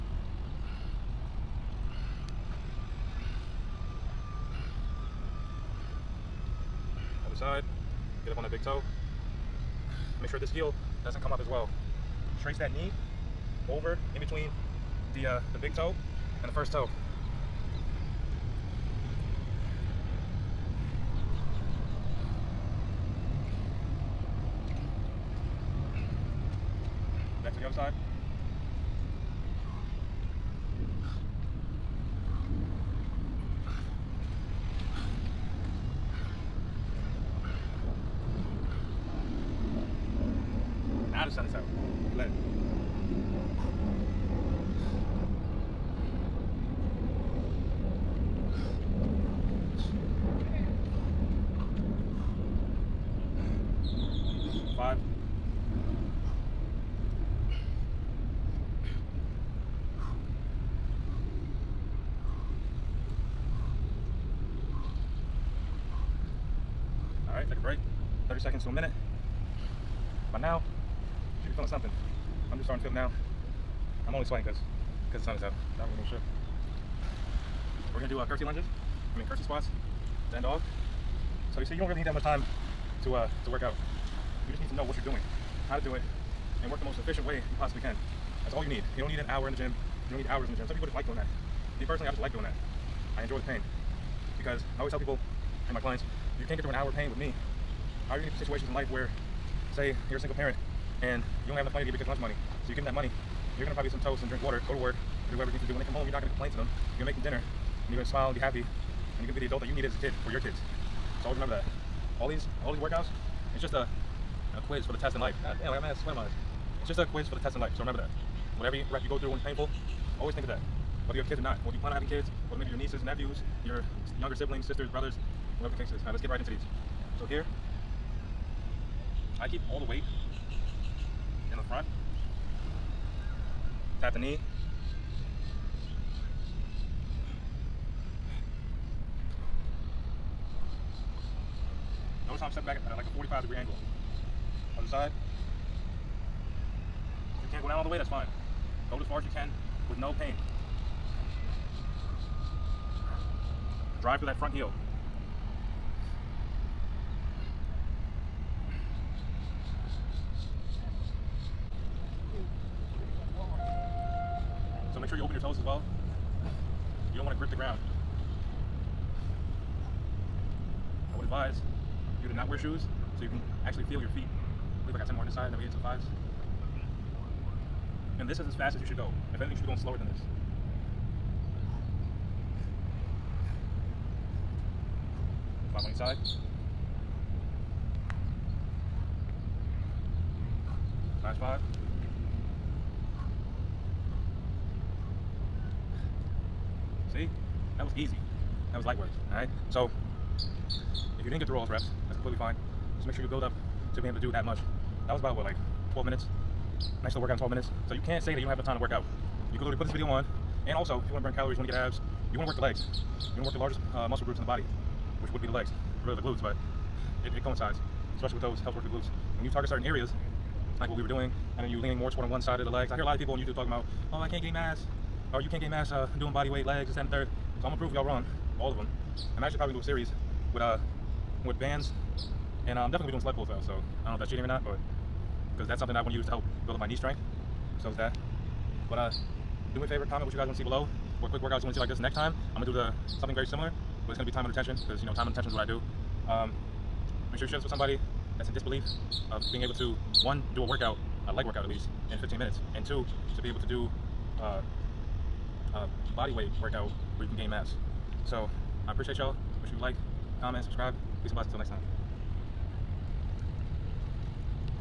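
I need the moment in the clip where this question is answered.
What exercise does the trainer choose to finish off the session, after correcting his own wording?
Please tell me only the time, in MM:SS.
01:19.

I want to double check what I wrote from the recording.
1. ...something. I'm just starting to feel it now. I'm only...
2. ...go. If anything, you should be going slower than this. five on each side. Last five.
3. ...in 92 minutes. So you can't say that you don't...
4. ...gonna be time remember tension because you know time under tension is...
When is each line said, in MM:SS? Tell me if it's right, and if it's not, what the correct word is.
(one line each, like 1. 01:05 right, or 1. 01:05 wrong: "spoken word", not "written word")
1. 01:11 right
2. 02:58 right
3. 03:27 wrong: "12", not "92"
4. 04:04 wrong: "under", not "remember".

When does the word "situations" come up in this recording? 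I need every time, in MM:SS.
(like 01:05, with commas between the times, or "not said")
01:38.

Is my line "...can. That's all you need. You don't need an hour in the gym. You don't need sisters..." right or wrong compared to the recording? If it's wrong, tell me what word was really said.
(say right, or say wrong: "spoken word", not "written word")
wrong: "hours", not "sisters".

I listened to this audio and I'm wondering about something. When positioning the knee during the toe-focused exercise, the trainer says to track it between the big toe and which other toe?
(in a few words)
first toe.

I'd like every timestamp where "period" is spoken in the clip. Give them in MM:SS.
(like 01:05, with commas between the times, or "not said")
not said.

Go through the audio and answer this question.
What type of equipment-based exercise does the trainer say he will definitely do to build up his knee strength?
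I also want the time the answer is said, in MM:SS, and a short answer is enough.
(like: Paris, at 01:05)
sled pulls, at 03:53.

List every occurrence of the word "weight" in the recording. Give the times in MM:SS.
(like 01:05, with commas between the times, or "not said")
02:09, 03:46, 04:16.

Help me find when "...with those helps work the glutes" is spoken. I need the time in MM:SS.
03:38.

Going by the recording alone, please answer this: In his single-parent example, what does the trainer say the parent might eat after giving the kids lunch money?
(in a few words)
toast.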